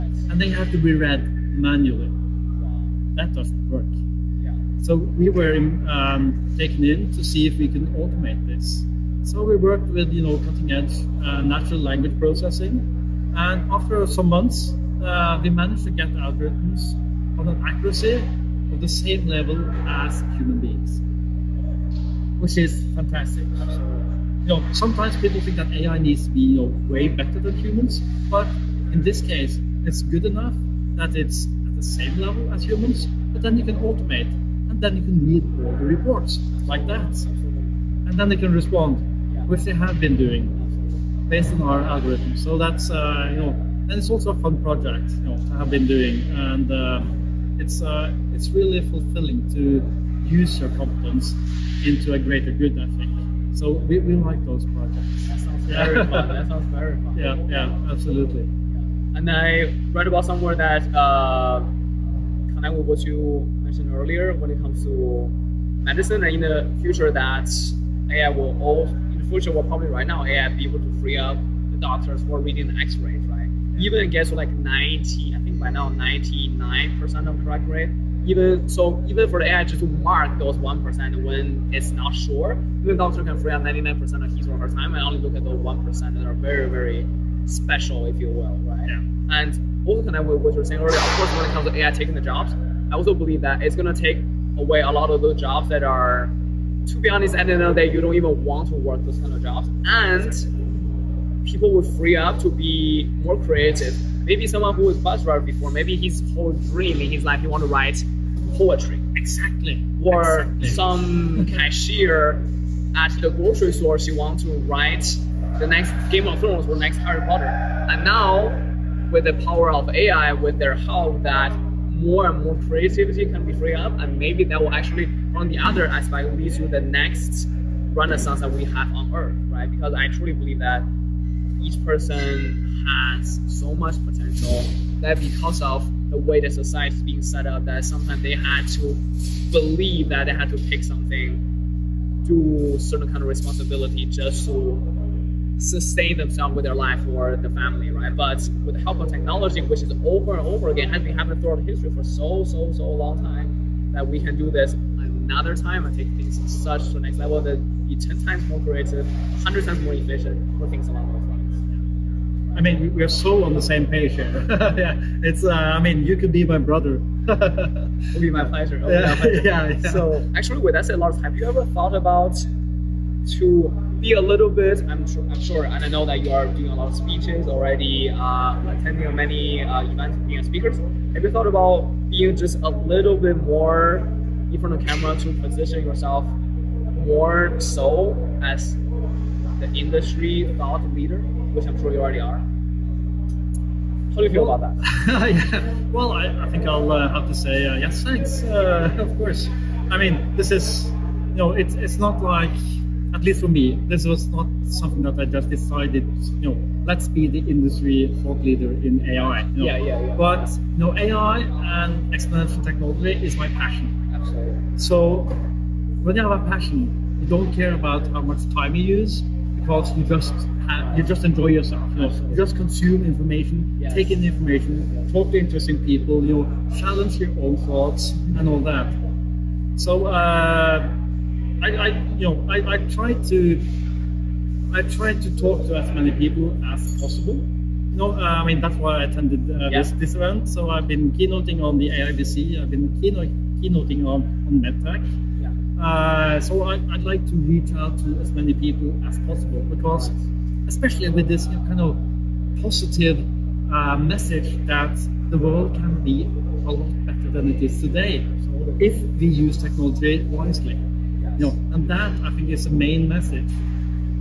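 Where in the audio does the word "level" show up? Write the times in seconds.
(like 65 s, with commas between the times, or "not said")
19 s, 32 s, 157 s.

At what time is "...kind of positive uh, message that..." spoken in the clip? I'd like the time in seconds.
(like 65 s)
251 s.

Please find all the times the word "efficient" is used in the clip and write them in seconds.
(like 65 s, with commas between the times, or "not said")
159 s.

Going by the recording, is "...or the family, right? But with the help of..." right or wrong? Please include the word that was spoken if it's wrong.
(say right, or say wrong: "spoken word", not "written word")
right.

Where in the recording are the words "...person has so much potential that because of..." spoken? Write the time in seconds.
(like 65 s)
131 s.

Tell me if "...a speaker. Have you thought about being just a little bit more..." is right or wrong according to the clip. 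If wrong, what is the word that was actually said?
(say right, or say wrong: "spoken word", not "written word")
right.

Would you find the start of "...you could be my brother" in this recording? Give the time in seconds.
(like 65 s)
166 s.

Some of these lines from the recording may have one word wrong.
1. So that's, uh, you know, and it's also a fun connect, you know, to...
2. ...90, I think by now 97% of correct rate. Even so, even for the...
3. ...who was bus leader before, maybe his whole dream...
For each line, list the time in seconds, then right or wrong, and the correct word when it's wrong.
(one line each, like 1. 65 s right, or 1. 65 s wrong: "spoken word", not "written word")
1. 42 s wrong: "project", not "connect"
2. 74 s wrong: "99", not "97"
3. 104 s wrong: "driver", not "leader".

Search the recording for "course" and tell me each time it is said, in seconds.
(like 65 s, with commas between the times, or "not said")
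91 s, 199 s.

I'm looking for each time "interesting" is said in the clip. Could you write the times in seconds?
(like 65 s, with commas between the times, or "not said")
225 s.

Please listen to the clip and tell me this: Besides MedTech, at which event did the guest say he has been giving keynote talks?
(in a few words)
AIBC.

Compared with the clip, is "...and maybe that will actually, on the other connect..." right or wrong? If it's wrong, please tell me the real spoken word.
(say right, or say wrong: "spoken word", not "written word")
wrong: "aspect", not "connect".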